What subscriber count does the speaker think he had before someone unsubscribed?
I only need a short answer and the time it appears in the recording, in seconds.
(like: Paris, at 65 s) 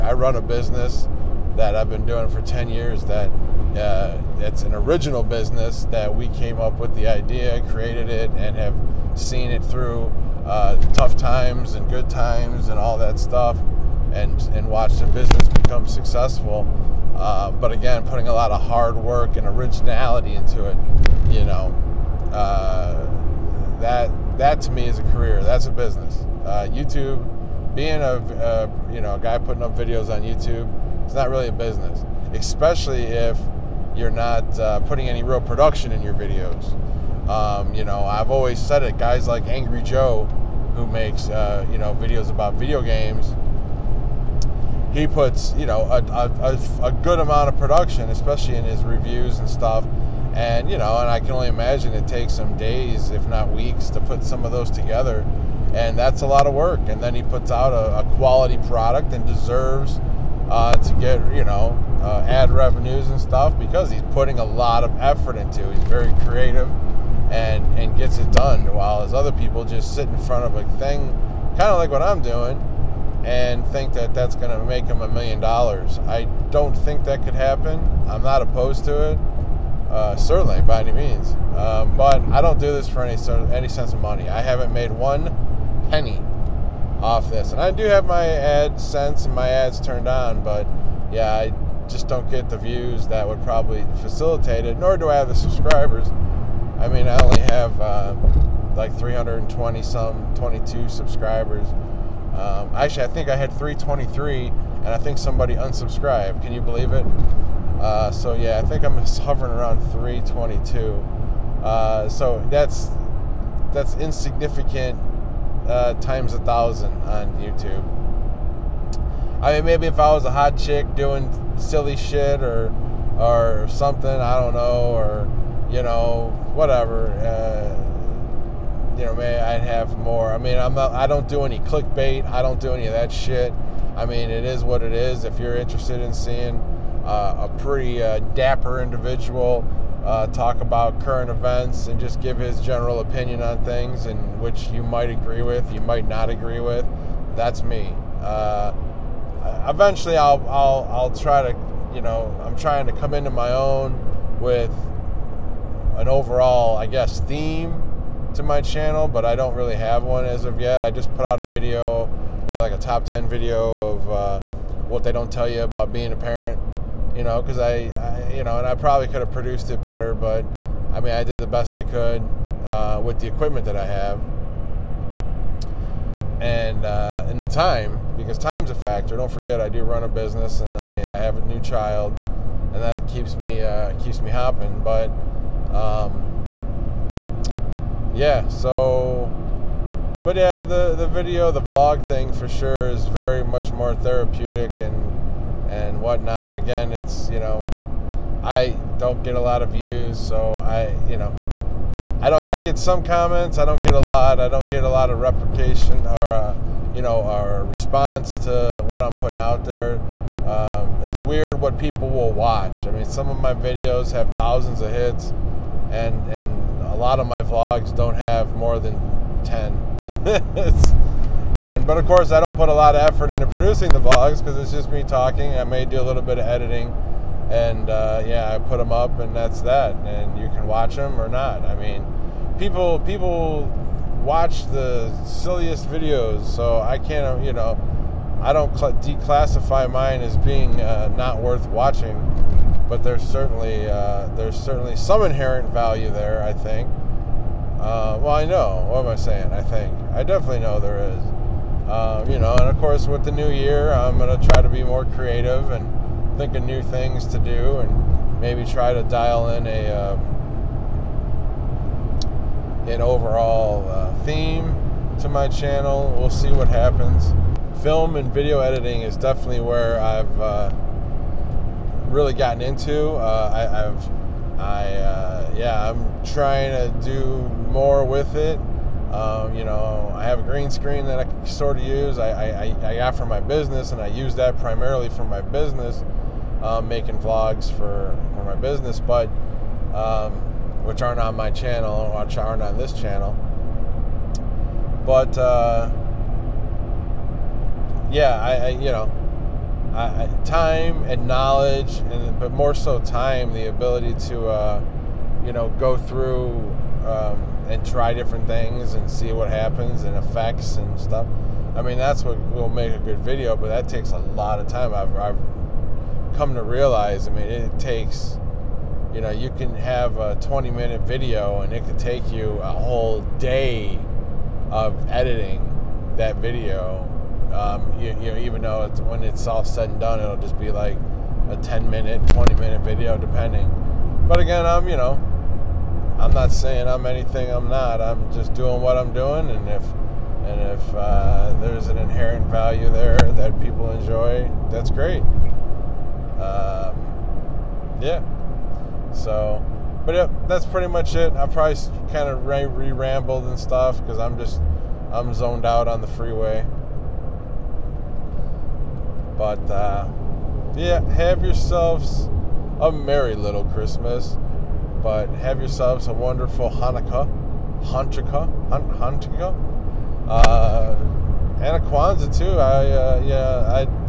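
323, at 103 s.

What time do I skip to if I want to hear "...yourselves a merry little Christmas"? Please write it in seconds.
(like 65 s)
361 s.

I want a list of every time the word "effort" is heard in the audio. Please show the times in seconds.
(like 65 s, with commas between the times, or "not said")
64 s, 223 s.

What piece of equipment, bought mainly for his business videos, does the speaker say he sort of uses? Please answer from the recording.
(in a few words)
green screen.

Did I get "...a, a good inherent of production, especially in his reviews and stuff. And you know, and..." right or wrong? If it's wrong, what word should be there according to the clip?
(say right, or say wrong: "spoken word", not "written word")
wrong: "amount", not "inherent".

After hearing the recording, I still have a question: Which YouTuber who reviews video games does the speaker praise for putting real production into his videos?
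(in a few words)
Angry Joe.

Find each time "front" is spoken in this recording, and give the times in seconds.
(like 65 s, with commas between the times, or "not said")
70 s.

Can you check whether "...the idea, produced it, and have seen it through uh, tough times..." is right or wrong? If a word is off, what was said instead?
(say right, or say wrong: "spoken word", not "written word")
wrong: "created", not "produced".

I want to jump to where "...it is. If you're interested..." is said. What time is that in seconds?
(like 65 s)
134 s.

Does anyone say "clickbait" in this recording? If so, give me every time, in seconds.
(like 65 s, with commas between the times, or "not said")
131 s.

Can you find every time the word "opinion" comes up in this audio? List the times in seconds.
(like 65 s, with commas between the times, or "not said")
142 s.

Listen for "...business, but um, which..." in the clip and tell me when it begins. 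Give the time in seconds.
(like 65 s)
288 s.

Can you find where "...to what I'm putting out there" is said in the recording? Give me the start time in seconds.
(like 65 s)
208 s.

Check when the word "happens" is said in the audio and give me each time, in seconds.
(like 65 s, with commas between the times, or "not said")
77 s, 266 s, 309 s.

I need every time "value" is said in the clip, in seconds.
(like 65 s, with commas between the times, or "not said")
245 s, 342 s.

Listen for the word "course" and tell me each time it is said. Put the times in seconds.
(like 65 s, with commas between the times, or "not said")
222 s, 252 s.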